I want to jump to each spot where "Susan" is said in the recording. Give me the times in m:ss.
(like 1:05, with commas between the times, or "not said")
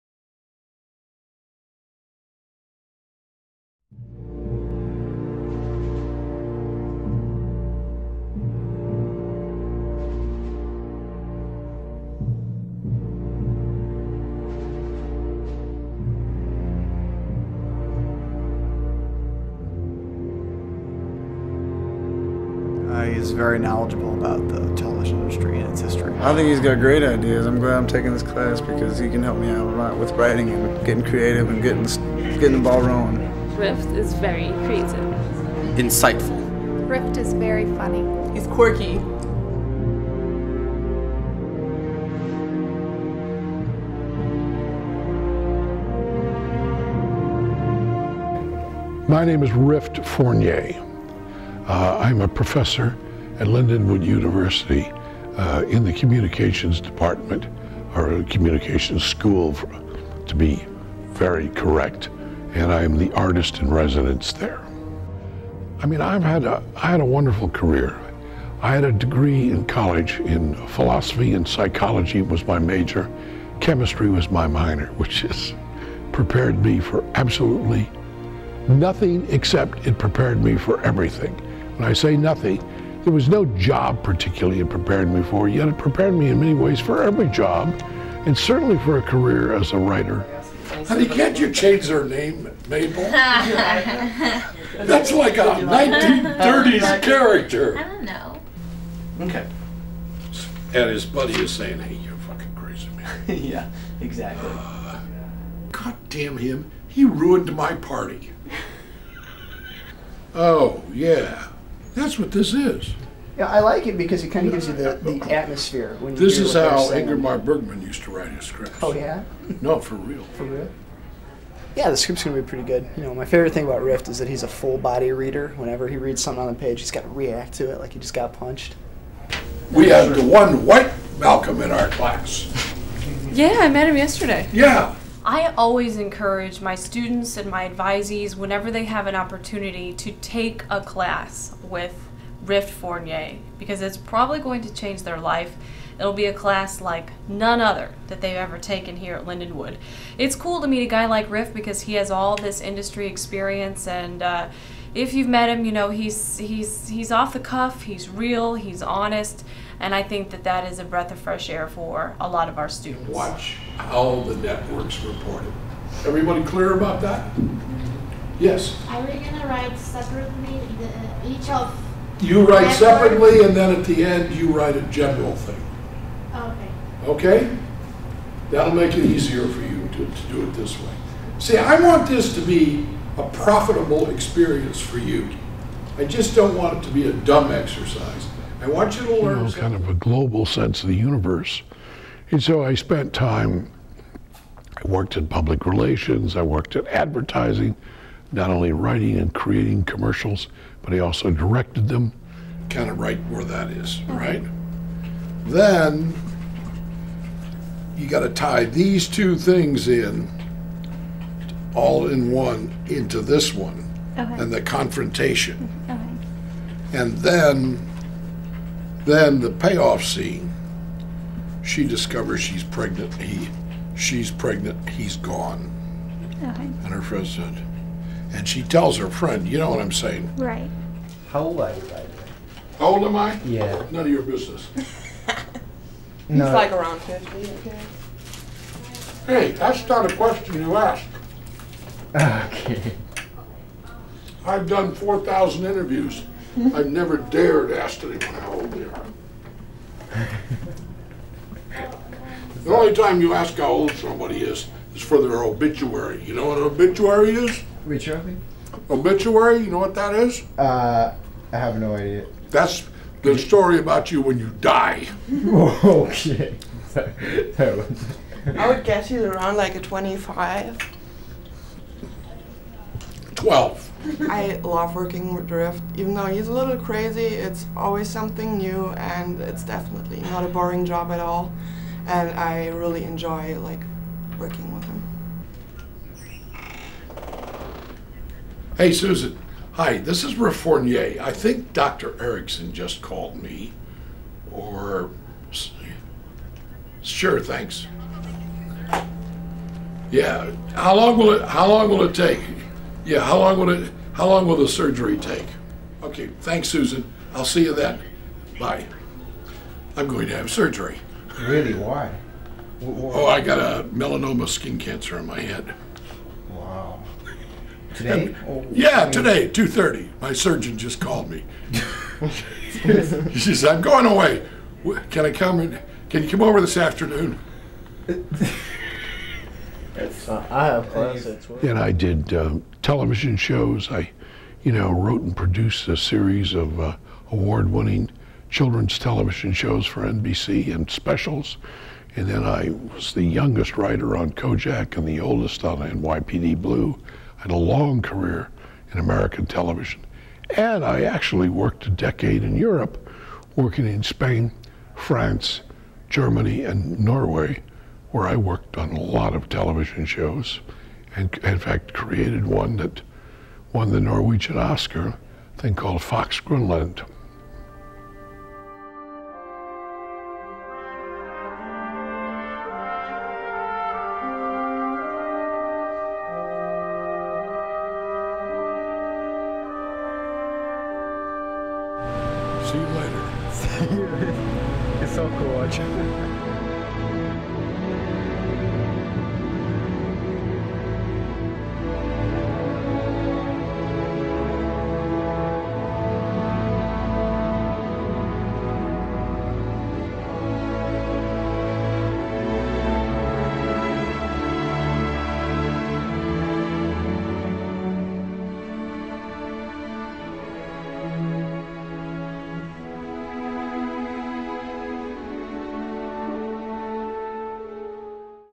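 4:48, 5:06.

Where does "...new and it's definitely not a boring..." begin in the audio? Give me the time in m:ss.
4:38.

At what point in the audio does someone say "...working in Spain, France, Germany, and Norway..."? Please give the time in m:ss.
5:53.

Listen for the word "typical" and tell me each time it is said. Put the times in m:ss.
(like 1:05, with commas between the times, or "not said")
not said.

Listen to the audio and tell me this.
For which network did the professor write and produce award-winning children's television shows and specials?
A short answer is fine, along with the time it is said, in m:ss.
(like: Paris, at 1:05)
NBC, at 5:40.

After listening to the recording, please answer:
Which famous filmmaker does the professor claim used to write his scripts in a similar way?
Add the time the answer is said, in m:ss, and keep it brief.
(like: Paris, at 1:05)
Ingmar Bergman, at 1:56.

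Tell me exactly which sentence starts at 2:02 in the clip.
You know, my favorite thing about Rift is that he's a full body reader.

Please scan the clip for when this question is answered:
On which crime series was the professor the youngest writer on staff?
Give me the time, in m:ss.
5:44.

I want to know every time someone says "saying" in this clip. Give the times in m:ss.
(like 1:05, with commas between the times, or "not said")
1:41, 3:49.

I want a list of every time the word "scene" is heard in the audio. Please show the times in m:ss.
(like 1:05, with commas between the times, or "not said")
3:40.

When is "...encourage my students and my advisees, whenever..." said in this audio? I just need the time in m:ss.
2:15.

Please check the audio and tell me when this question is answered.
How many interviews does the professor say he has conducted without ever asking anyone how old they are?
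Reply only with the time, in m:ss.
4:04.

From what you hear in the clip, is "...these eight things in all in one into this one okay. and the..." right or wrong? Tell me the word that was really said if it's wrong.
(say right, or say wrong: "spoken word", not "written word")
wrong: "two", not "eight".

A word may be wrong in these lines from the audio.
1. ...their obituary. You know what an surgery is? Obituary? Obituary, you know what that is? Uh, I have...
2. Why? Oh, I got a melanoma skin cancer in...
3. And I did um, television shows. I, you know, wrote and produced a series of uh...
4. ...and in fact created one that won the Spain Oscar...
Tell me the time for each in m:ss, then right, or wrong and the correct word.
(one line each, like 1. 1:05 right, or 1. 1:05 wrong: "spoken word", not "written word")
1. 4:15 wrong: "obituary", not "surgery"
2. 5:12 right
3. 5:31 right
4. 6:01 wrong: "Norwegian", not "Spain".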